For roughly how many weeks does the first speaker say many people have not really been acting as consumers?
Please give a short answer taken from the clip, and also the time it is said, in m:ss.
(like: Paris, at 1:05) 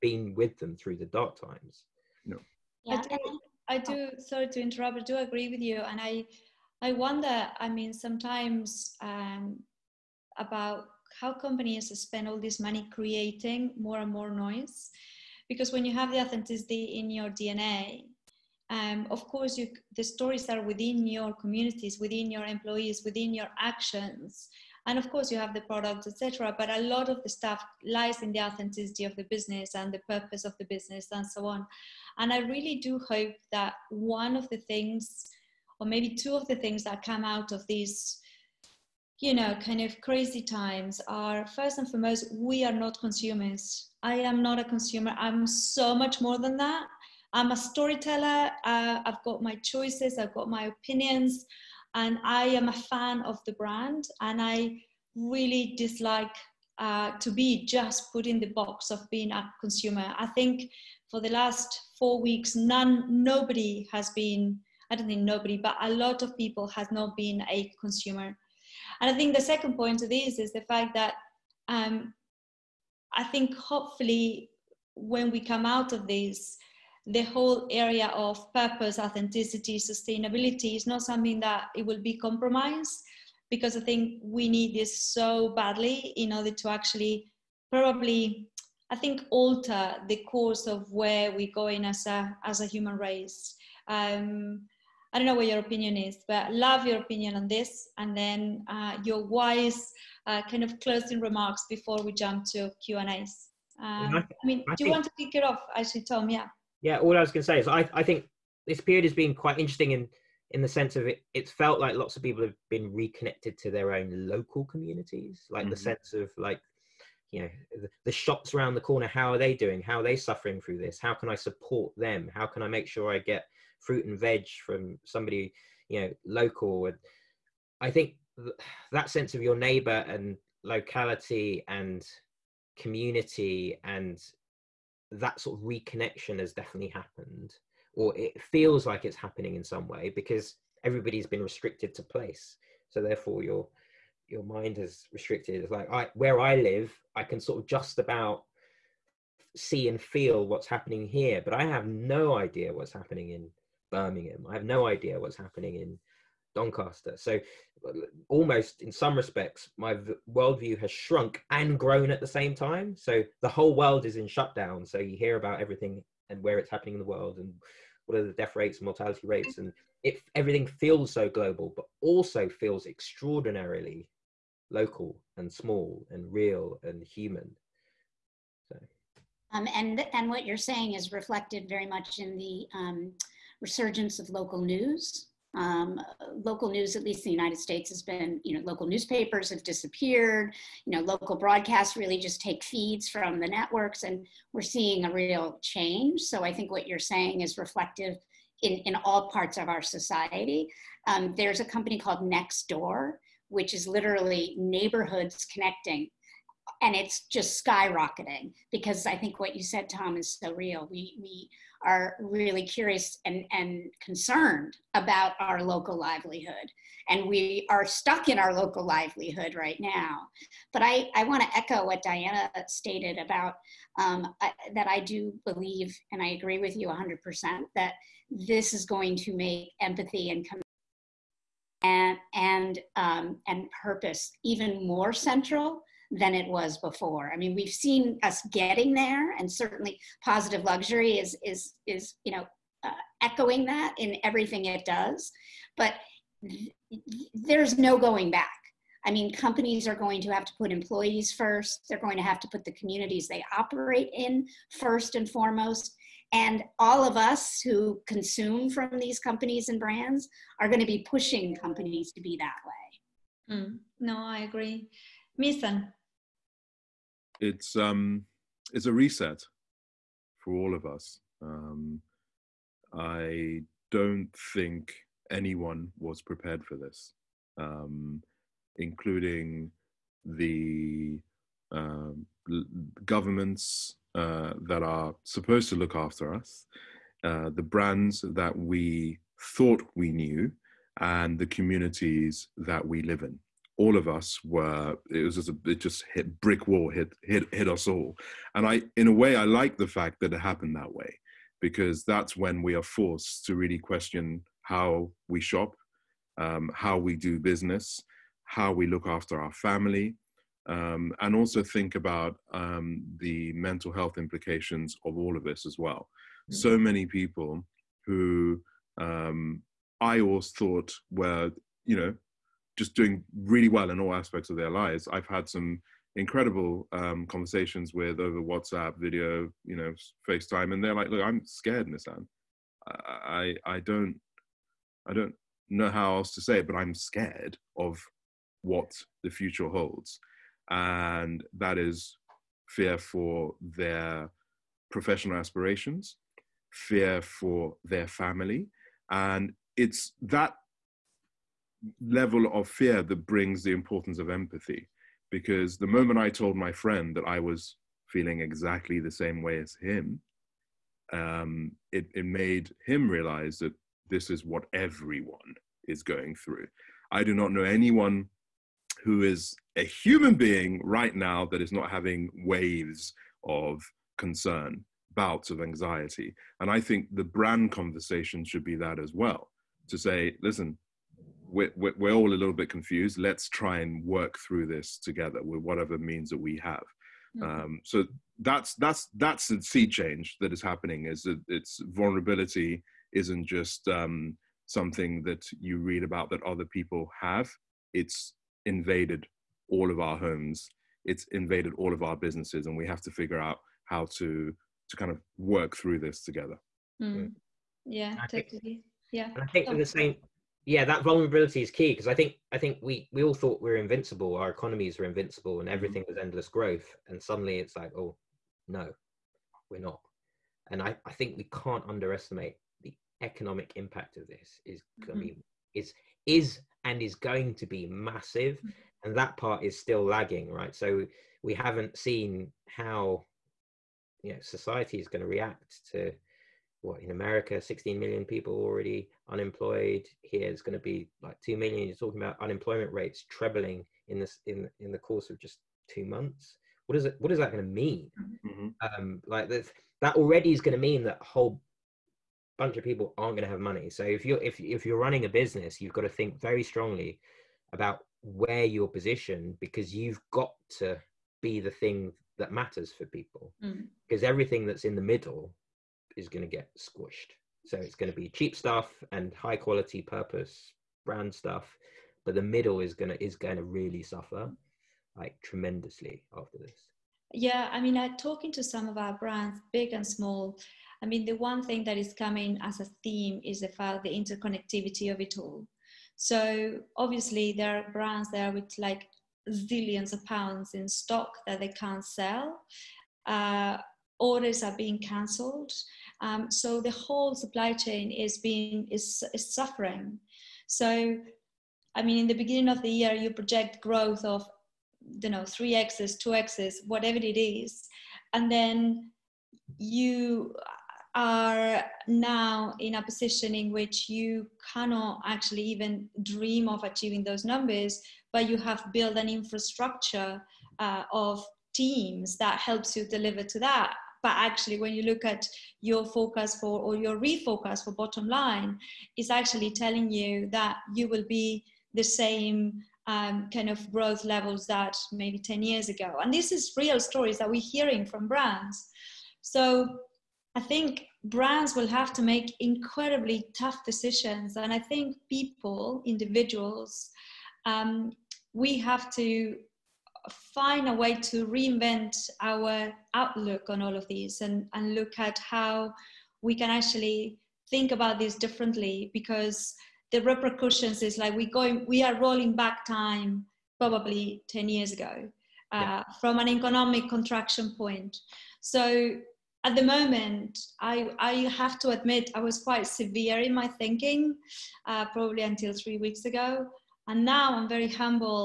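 4 weeks, at 1:01.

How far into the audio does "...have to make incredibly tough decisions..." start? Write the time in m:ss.
9:01.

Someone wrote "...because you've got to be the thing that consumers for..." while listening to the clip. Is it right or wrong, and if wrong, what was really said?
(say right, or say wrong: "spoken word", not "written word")
wrong: "matters", not "consumers".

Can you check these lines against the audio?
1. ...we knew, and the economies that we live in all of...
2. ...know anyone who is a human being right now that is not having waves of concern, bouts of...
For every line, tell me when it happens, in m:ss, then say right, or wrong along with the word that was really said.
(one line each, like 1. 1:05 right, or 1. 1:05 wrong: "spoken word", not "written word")
1. 4:49 wrong: "communities", not "economies"
2. 6:07 right.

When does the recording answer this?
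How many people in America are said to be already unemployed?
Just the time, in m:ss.
7:17.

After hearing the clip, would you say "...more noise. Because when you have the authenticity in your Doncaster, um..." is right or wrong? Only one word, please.
wrong.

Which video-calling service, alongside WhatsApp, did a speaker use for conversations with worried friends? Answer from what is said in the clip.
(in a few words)
FaceTime.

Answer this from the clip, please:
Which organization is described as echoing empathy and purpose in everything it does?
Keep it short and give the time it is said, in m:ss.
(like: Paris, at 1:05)
Positive Luxury, at 4:00.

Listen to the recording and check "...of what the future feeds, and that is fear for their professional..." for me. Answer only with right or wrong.
wrong.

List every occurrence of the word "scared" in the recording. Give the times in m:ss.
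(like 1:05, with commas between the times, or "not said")
5:31, 5:36.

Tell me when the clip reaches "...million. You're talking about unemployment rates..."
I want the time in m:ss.
7:21.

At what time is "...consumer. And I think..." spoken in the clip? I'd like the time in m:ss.
1:07.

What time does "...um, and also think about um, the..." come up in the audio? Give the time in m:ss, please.
5:10.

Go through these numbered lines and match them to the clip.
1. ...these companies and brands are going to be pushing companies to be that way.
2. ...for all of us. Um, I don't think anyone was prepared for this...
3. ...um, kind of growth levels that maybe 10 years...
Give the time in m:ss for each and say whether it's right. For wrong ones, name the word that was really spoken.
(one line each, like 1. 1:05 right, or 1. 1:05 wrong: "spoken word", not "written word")
1. 4:18 right
2. 4:30 right
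3. 8:53 right.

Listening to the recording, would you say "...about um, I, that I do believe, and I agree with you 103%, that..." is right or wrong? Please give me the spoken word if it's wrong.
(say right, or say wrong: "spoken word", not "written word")
wrong: "100", not "103".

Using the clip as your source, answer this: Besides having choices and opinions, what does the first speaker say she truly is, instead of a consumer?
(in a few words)
A storyteller.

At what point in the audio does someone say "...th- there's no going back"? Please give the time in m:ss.
4:06.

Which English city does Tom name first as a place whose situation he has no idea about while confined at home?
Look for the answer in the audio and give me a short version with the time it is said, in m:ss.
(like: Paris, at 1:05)
Birmingham, at 2:33.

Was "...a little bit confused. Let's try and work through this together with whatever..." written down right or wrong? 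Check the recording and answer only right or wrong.
right.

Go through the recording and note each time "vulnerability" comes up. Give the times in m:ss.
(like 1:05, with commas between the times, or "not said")
6:31, 6:51.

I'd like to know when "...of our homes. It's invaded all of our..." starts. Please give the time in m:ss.
6:39.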